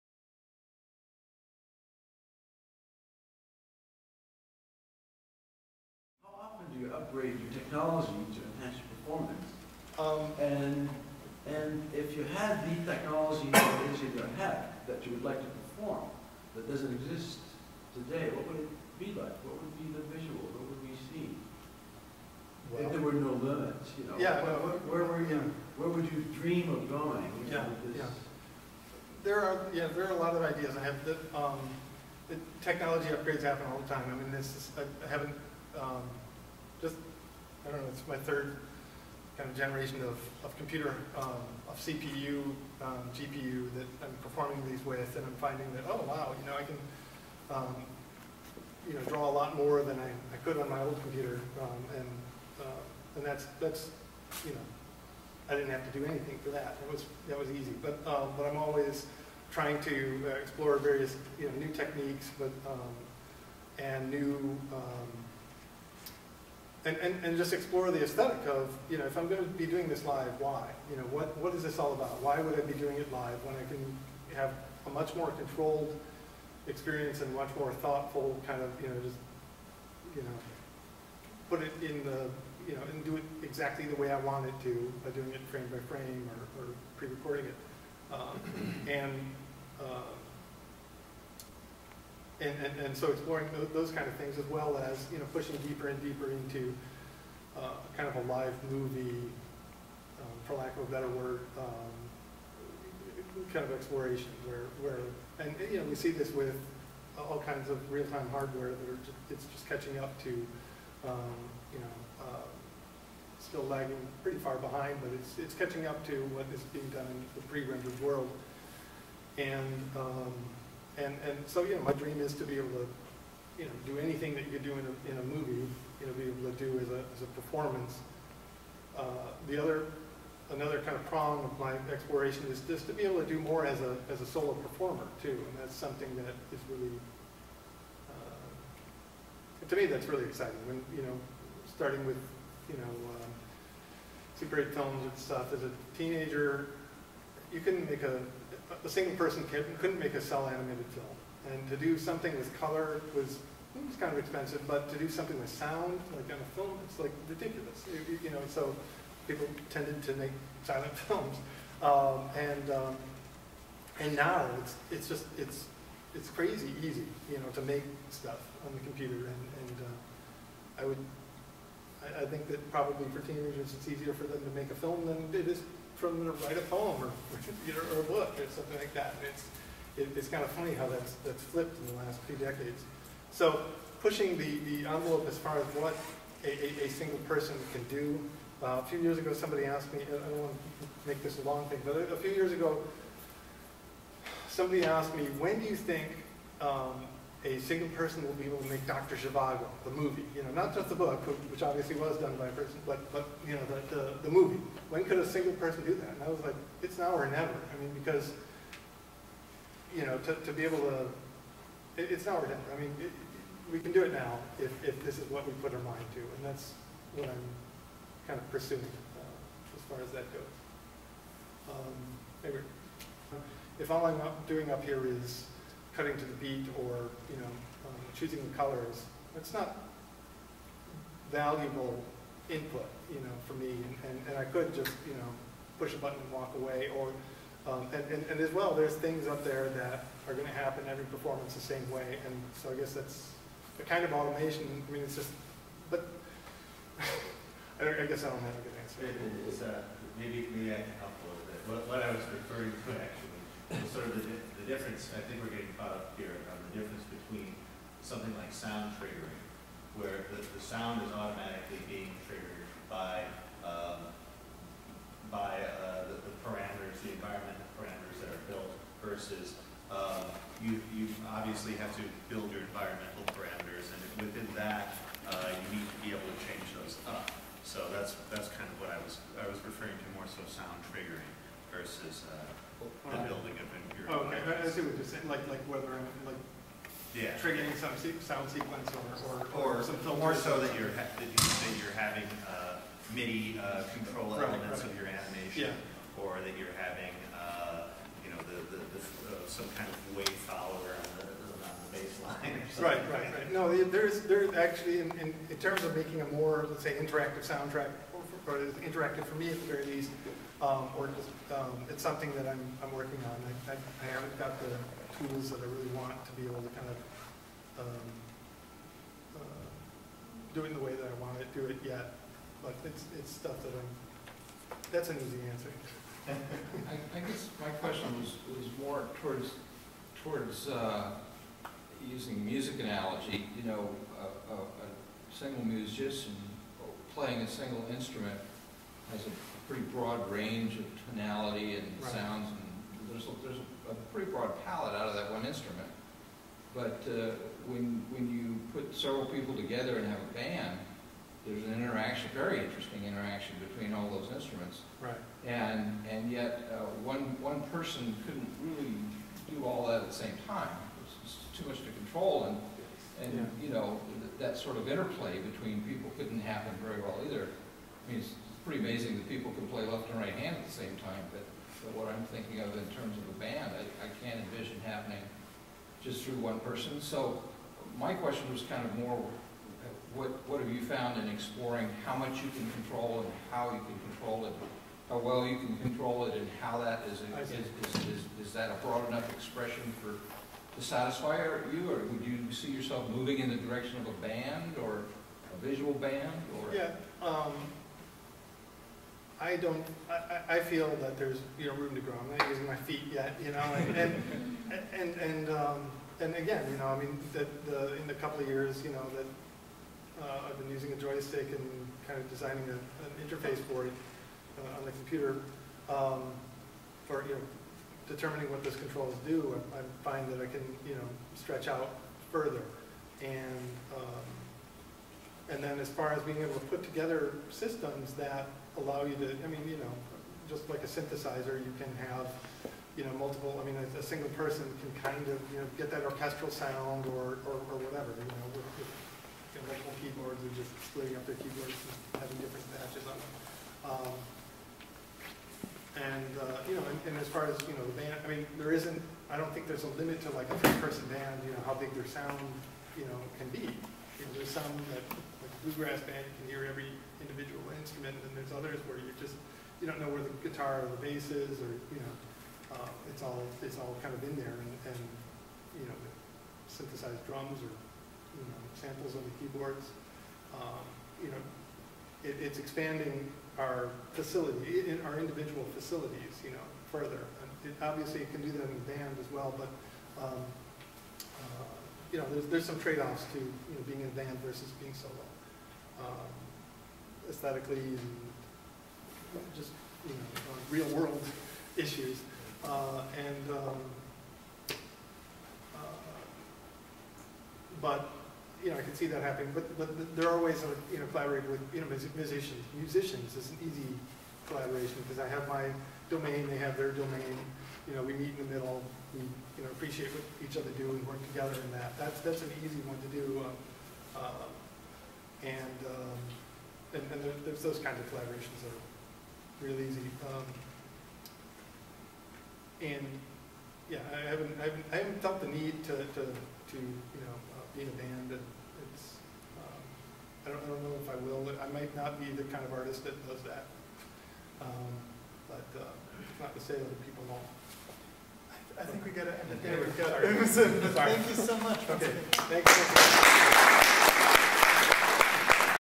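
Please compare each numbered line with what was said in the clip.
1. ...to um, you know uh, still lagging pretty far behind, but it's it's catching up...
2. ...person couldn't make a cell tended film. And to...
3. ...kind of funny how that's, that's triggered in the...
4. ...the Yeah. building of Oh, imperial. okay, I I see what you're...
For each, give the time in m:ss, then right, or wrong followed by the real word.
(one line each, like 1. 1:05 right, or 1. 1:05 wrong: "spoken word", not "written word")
1. 1:50 right
2. 2:29 wrong: "animated", not "tended"
3. 3:00 wrong: "flipped", not "triggered"
4. 4:43 wrong: "Okay", not "Yeah".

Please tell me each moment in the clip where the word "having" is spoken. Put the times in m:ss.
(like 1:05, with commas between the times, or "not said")
4:51, 4:56, 7:22.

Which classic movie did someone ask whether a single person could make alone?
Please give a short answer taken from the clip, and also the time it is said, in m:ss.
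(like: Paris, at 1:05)
Dr. Zhivago, at 3:18.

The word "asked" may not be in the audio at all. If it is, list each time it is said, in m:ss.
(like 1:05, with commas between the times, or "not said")
3:09, 3:14.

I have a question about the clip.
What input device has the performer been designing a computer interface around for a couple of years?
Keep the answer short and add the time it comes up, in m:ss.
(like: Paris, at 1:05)
joystick, at 6:50.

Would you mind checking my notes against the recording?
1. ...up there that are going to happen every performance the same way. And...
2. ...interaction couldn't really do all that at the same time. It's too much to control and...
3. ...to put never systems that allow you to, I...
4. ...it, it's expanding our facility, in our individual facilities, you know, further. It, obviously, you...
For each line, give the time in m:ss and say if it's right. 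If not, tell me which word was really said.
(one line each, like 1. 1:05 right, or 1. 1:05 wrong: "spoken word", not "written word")
1. 3:59 right
2. 5:57 wrong: "person", not "interaction"
3. 7:06 wrong: "together", not "never"
4. 7:52 right.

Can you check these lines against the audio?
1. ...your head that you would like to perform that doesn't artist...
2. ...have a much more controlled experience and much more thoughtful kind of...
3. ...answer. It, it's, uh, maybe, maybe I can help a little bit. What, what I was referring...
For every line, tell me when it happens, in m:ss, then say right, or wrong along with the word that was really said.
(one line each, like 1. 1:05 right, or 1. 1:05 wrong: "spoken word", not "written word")
1. 0:14 wrong: "exist", not "artist"
2. 1:14 right
3. 4:08 right.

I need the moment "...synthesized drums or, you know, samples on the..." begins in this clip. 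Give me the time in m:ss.
7:46.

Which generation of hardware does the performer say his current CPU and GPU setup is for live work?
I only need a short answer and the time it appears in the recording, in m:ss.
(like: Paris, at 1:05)
third, at 0:38.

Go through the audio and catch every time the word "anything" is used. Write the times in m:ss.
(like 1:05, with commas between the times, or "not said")
0:56, 2:03.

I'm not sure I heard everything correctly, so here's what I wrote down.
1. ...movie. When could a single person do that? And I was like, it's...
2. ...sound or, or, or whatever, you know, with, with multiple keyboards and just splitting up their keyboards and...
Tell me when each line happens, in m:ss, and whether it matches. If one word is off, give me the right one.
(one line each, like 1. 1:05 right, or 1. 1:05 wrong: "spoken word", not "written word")
1. 3:24 right
2. 7:16 right.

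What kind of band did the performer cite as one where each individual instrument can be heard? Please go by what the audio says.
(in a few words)
bluegrass.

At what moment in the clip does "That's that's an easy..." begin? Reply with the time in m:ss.
8:31.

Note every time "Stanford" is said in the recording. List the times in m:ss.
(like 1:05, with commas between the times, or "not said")
not said.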